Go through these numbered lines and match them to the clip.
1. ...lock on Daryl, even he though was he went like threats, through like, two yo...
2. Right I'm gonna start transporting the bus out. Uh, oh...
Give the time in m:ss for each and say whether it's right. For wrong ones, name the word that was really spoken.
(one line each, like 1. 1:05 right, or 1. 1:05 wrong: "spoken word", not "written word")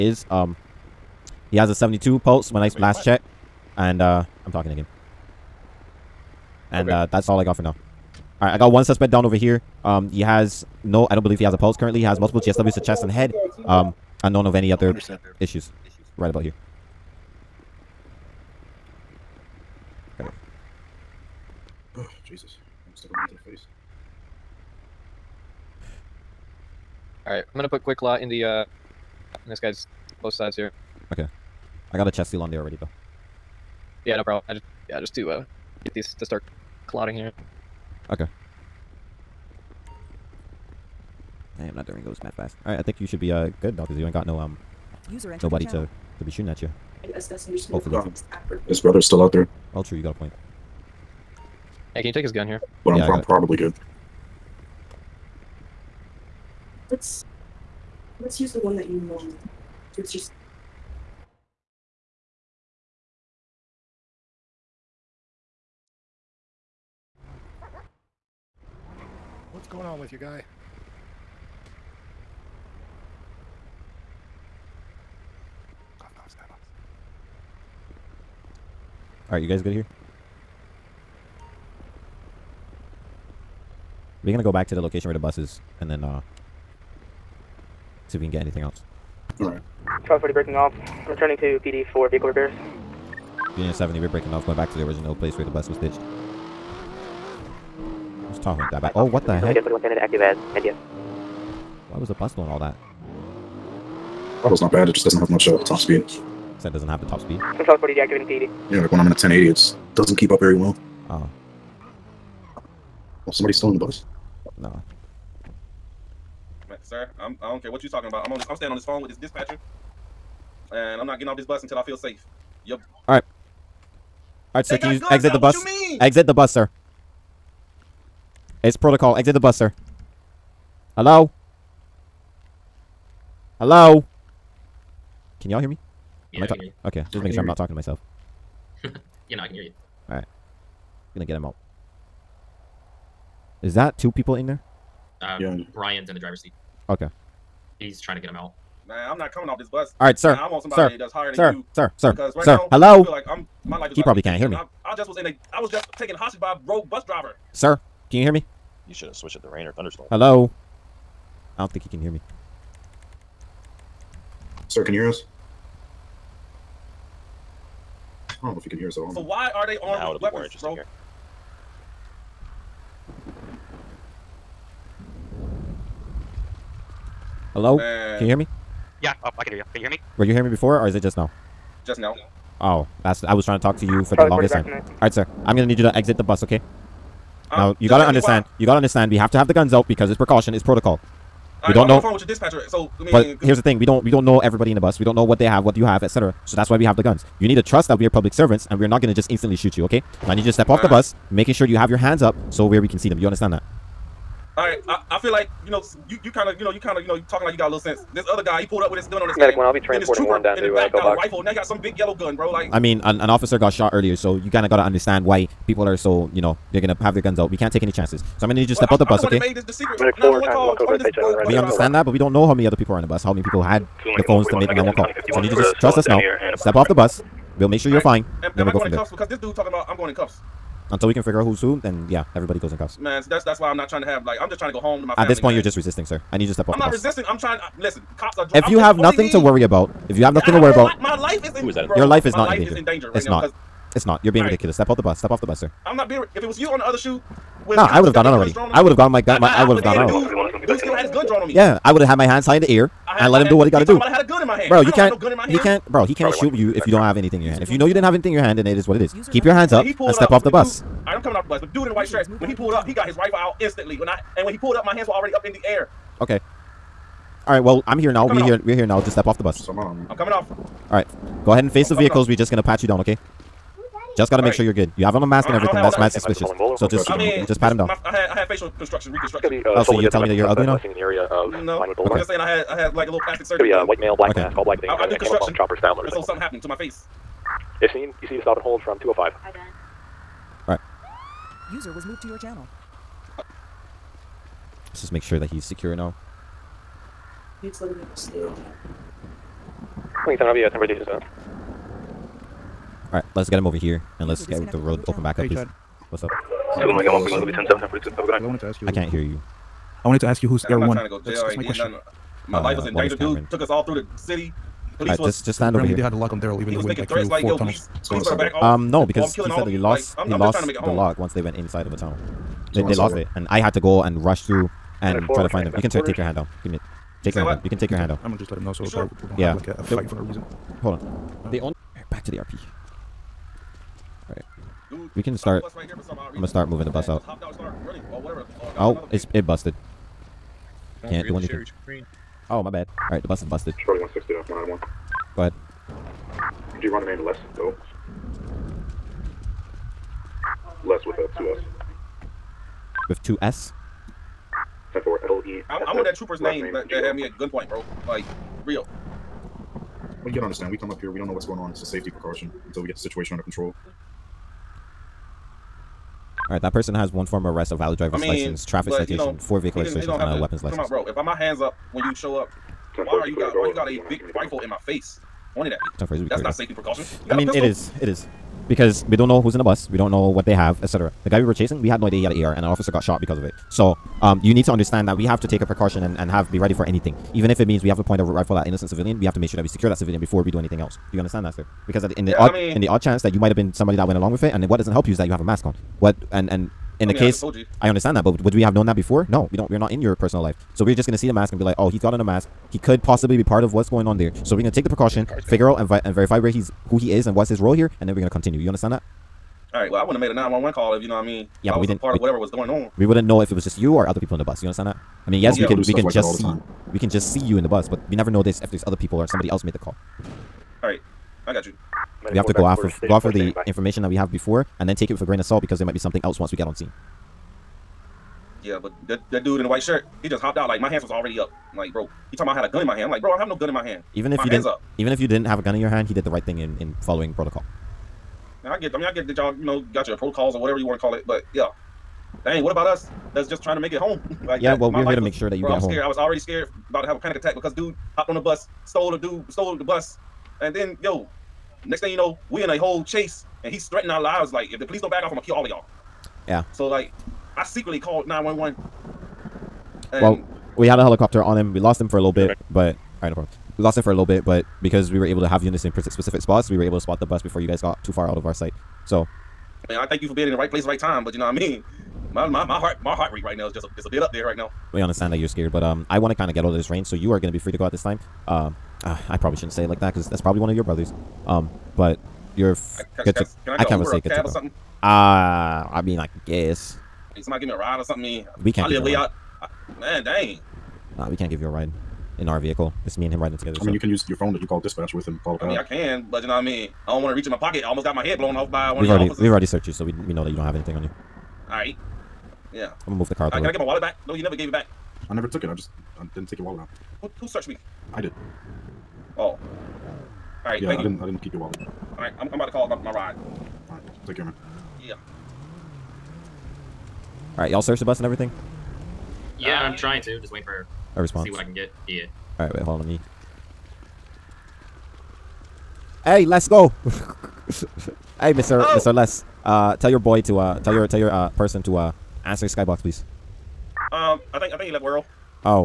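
1. 5:16 wrong: "four", not "two"
2. 5:35 wrong: "moving", not "transporting".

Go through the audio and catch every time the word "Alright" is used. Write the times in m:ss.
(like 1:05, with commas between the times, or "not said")
0:27, 1:19, 1:29, 5:03.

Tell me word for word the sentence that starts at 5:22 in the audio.
They, they lost it, and I had to go and rush through and try to find him.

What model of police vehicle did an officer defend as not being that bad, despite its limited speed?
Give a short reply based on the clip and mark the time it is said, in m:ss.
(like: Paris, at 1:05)
Tahoe, at 1:38.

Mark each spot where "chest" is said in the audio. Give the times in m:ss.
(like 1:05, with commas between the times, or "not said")
0:12, 0:32.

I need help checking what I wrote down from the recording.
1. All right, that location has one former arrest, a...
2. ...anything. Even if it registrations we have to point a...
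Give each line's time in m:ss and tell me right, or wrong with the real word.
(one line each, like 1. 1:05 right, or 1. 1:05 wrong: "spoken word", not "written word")
1. 6:06 wrong: "person", not "location"
2. 6:26 wrong: "means", not "registrations".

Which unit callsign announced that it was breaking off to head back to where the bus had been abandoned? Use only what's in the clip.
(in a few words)
Union 70.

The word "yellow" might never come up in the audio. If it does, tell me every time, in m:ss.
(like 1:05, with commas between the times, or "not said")
3:31.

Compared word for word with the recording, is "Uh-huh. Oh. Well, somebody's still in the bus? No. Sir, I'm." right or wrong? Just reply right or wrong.
right.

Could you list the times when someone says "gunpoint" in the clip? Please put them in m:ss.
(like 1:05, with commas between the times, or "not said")
5:57.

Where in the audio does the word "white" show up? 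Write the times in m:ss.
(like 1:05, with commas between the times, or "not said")
4:21, 4:43, 7:09.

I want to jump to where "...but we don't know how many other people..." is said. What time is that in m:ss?
3:42.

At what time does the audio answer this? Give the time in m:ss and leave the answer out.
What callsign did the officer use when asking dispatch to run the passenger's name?
5:43.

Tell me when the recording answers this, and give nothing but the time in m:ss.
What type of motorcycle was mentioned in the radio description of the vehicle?
4:45.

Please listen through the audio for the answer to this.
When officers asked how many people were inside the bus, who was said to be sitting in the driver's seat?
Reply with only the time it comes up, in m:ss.
2:25.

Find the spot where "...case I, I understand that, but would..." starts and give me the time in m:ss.
6:37.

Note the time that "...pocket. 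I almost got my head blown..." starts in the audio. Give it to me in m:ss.
8:17.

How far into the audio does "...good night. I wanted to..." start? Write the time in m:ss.
5:08.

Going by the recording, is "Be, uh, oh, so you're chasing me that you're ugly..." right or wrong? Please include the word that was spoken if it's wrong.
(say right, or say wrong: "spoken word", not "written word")
wrong: "telling", not "chasing".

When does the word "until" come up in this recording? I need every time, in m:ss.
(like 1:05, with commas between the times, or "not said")
2:01, 3:50, 6:02.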